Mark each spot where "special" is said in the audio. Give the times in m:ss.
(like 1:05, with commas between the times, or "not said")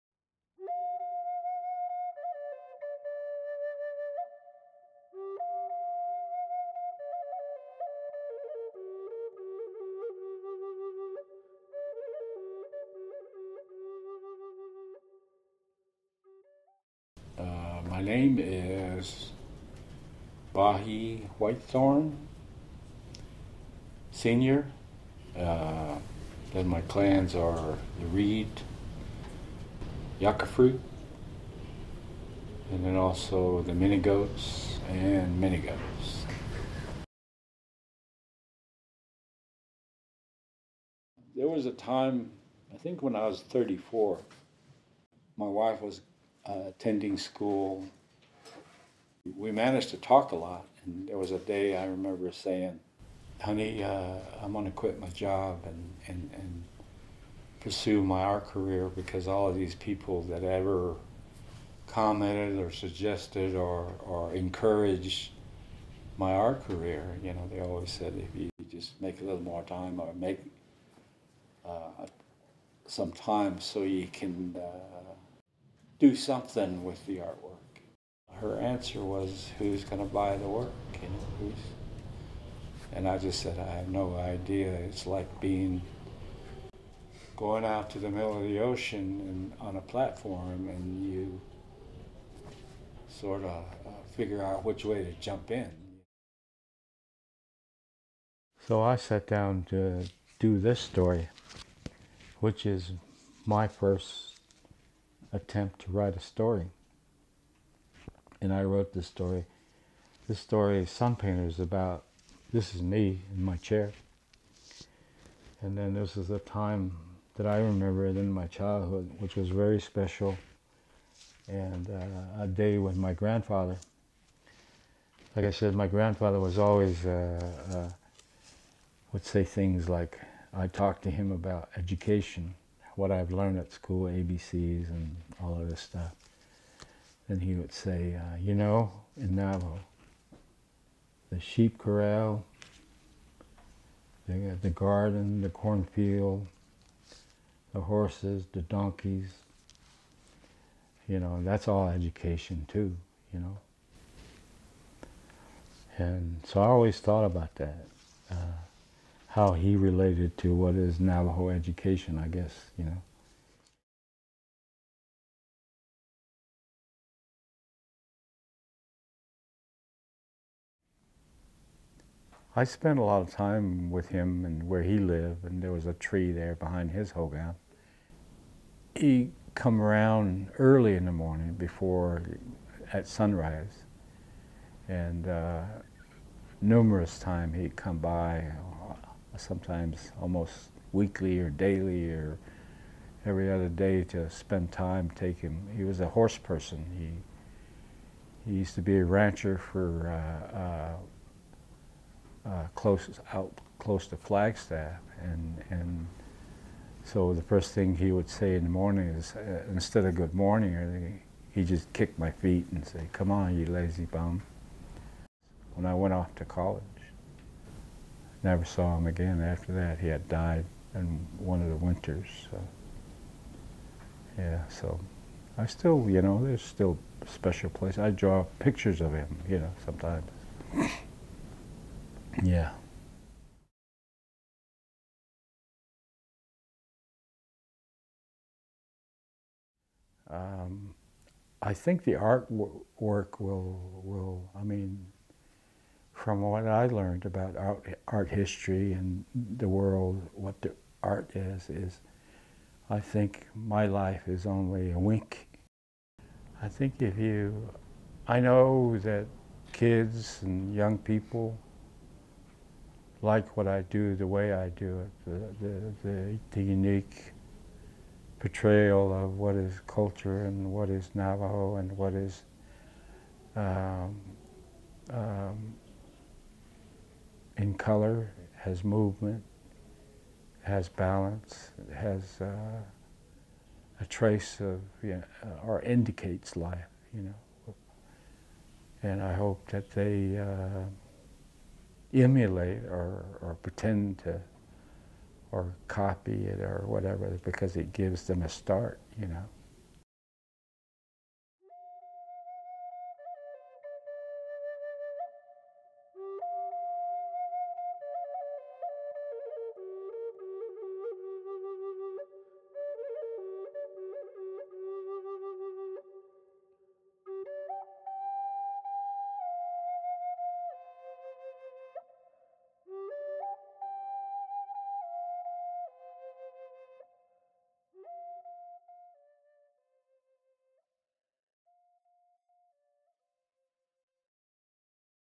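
1:59, 3:47.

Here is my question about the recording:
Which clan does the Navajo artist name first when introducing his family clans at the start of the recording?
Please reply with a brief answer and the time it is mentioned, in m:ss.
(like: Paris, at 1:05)
Reed, at 0:28.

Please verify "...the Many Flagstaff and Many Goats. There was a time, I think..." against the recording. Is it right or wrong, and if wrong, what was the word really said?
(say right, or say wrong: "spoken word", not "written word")
wrong: "Goats", not "Flagstaff".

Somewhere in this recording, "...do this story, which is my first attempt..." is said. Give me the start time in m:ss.
1:40.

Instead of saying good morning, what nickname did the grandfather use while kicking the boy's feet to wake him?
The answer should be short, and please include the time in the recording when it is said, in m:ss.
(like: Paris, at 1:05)
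lazy bum, at 3:33.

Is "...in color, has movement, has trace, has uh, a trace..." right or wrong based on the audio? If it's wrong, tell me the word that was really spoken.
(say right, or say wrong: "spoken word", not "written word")
wrong: "balance", not "trace".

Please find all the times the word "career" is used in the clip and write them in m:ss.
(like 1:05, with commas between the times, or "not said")
0:58, 1:06.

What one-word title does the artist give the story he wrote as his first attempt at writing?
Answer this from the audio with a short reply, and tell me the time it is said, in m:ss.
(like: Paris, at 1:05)
Sun, at 1:50.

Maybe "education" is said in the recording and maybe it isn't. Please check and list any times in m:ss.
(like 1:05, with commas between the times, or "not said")
2:11, 2:31, 2:41.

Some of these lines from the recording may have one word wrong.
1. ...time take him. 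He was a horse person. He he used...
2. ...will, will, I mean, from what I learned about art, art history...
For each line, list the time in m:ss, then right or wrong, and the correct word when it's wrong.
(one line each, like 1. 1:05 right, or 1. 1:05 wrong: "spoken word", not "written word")
1. 3:14 right
2. 4:03 right.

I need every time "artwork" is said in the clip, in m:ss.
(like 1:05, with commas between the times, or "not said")
1:17, 4:02.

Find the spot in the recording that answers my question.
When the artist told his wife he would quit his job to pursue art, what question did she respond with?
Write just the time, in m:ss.
1:19.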